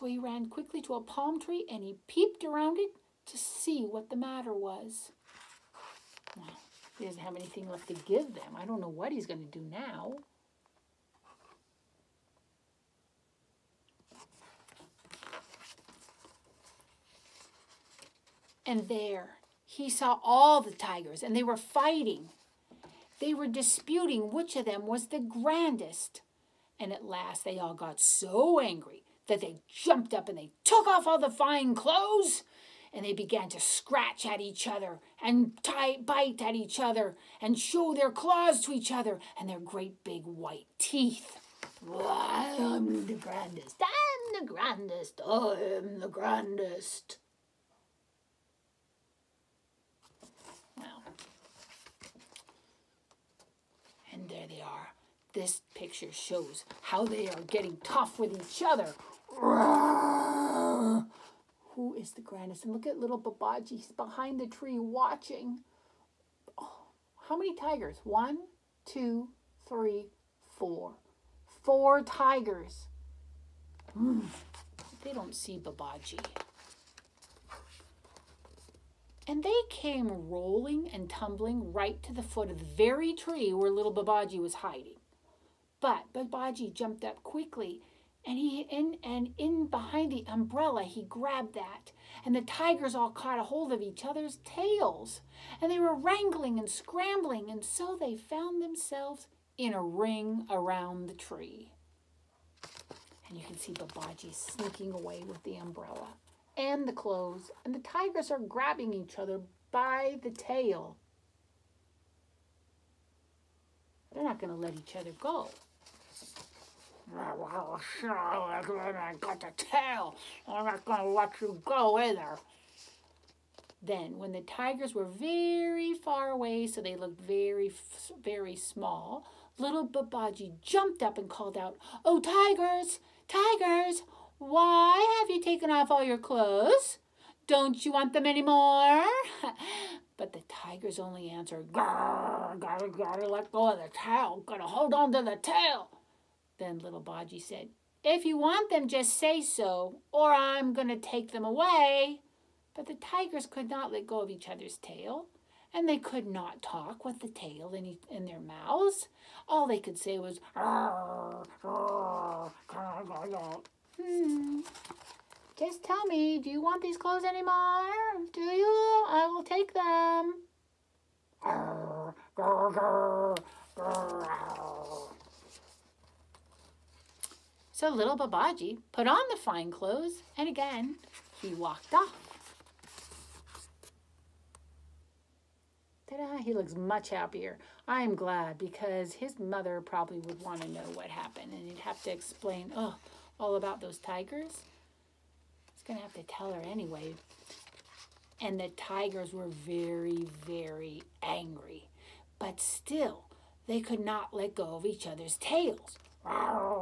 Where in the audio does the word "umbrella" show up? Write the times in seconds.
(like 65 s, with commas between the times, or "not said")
90 s, 105 s.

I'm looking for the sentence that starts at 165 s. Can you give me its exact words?
Just tell me, do you want these clothes anymore?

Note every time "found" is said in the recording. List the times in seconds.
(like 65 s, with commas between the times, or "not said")
98 s.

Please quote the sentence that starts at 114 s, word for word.
They're not going to let each other go.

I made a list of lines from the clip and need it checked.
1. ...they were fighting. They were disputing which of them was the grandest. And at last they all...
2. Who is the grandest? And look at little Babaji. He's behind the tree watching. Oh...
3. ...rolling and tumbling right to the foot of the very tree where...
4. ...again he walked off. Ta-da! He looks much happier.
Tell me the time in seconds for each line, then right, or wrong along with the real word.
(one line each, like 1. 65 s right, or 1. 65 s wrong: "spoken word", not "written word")
1. 21 s right
2. 61 s right
3. 80 s right
4. 180 s right.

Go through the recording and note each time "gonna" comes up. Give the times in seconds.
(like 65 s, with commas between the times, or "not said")
150 s.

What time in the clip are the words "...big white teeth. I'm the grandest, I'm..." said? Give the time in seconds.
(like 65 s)
40 s.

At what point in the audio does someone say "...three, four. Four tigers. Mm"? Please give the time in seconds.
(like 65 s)
69 s.